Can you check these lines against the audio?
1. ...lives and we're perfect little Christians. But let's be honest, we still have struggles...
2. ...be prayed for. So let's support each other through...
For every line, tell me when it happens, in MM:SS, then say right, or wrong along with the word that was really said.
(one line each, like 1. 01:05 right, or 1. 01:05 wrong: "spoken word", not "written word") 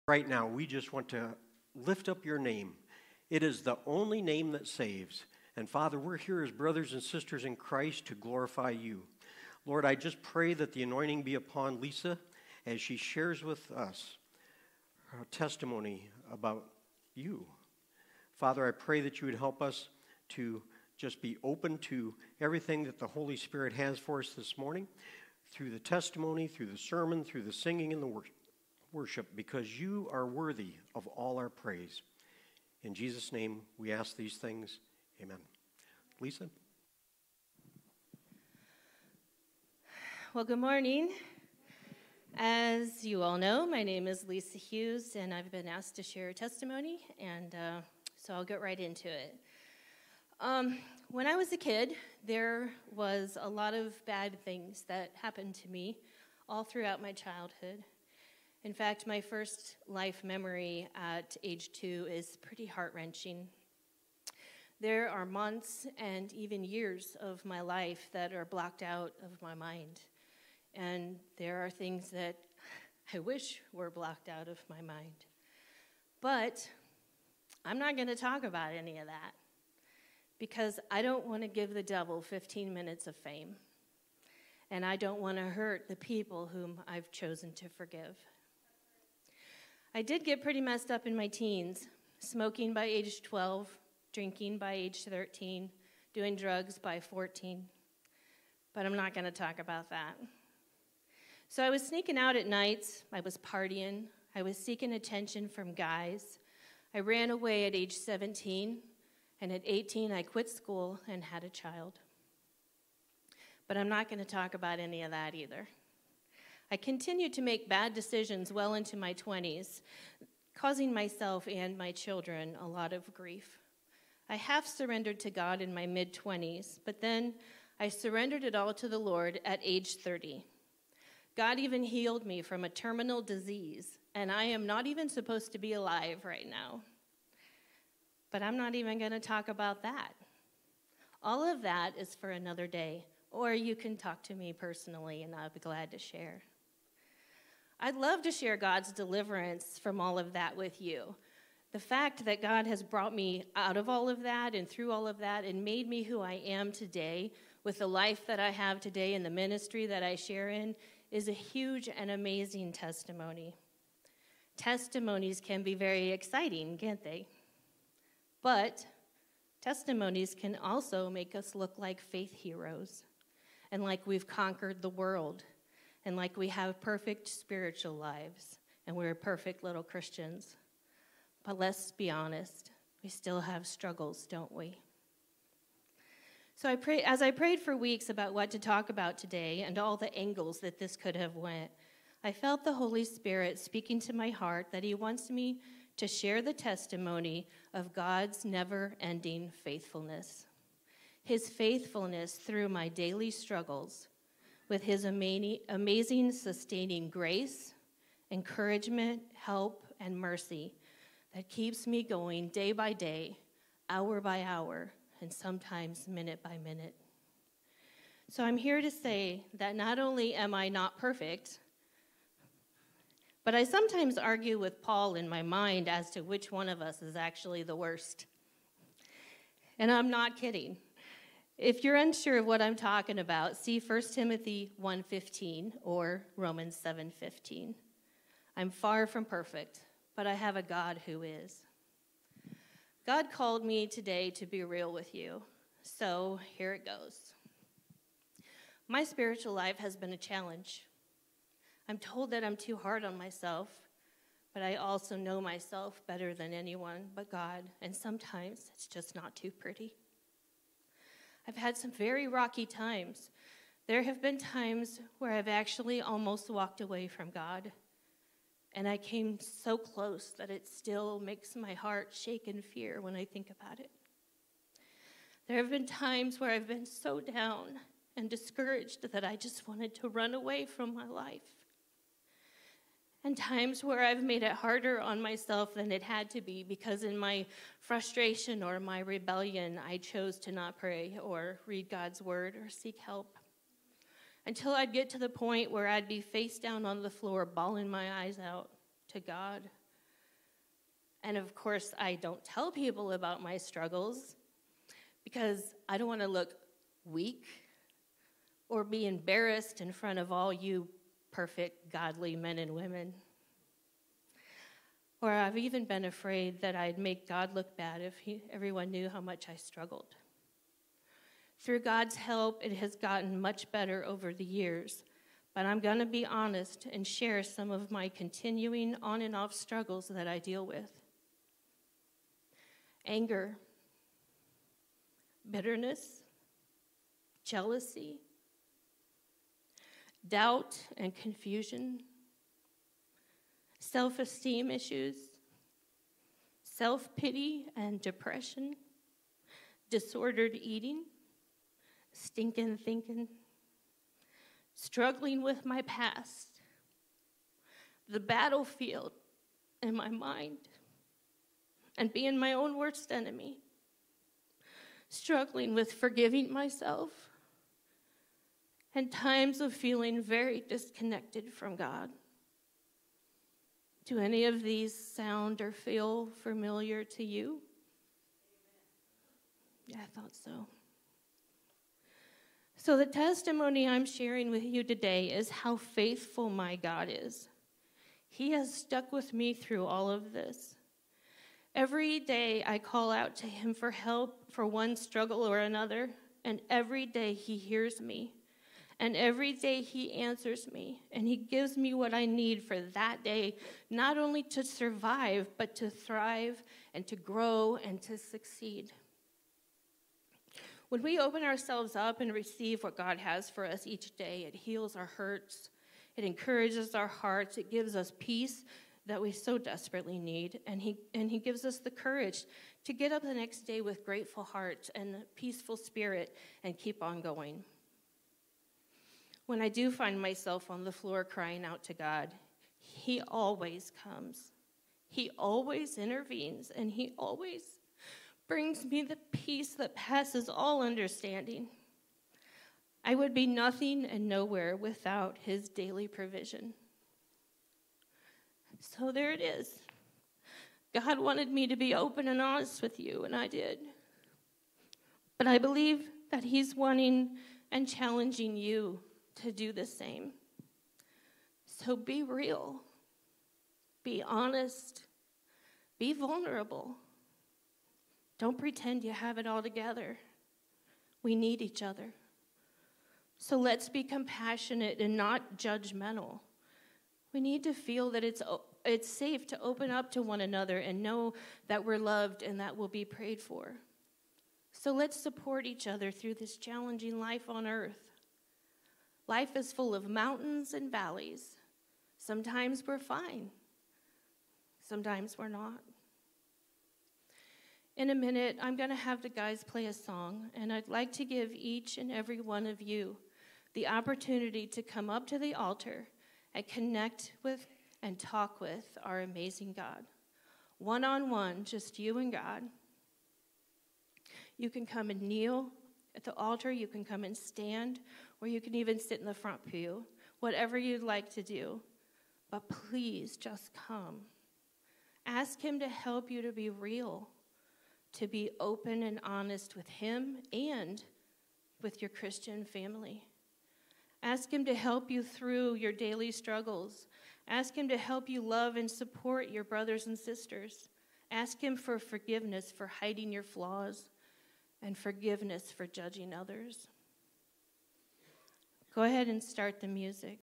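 1. 02:57 right
2. 08:02 right.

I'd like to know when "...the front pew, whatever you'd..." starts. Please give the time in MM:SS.
08:39.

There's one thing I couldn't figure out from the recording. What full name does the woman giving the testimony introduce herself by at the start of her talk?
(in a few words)
Lisa Hughes.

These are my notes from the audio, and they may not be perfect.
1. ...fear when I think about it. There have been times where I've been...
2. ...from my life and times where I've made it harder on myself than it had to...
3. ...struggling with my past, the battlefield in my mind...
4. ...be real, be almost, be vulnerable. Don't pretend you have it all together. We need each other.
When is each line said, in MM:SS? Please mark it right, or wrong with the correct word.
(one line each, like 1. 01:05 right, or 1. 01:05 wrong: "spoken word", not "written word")
1. 04:32 right
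2. 04:40 right
3. 05:54 right
4. 07:41 wrong: "honest", not "almost".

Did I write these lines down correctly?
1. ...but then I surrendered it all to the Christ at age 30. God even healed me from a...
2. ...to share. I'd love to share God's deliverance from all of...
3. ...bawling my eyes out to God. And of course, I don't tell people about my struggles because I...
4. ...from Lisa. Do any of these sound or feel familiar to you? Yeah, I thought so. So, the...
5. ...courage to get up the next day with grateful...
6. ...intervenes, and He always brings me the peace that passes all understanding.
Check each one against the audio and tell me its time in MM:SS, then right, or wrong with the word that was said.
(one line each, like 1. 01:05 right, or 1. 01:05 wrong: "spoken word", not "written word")
1. 02:06 wrong: "Lord", not "Christ"
2. 02:25 right
3. 04:57 right
4. 06:11 wrong: "God", not "Lisa"
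5. 07:01 right
6. 07:15 right.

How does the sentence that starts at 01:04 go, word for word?
There are months and even years of my life that are blocked out of my mind.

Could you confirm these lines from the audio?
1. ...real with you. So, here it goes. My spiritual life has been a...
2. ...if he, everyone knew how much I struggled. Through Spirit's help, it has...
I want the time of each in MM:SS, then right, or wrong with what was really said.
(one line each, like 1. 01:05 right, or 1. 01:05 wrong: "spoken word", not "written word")
1. 04:04 right
2. 05:18 wrong: "God", not "Spirit".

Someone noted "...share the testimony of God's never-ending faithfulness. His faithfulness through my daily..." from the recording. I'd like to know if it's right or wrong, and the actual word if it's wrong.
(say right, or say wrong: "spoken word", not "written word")
right.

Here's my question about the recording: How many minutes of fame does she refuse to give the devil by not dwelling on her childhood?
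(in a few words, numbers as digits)
15.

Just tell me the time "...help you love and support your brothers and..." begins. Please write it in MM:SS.
08:57.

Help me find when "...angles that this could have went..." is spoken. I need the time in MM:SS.
03:10.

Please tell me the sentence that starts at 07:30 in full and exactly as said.
God wanted me to be open and honest with you, and I did.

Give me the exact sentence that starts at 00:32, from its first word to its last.
In Jesus' name, we ask these things.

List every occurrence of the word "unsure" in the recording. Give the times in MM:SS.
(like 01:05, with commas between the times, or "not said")
03:51.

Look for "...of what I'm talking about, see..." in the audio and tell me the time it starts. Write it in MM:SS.
03:52.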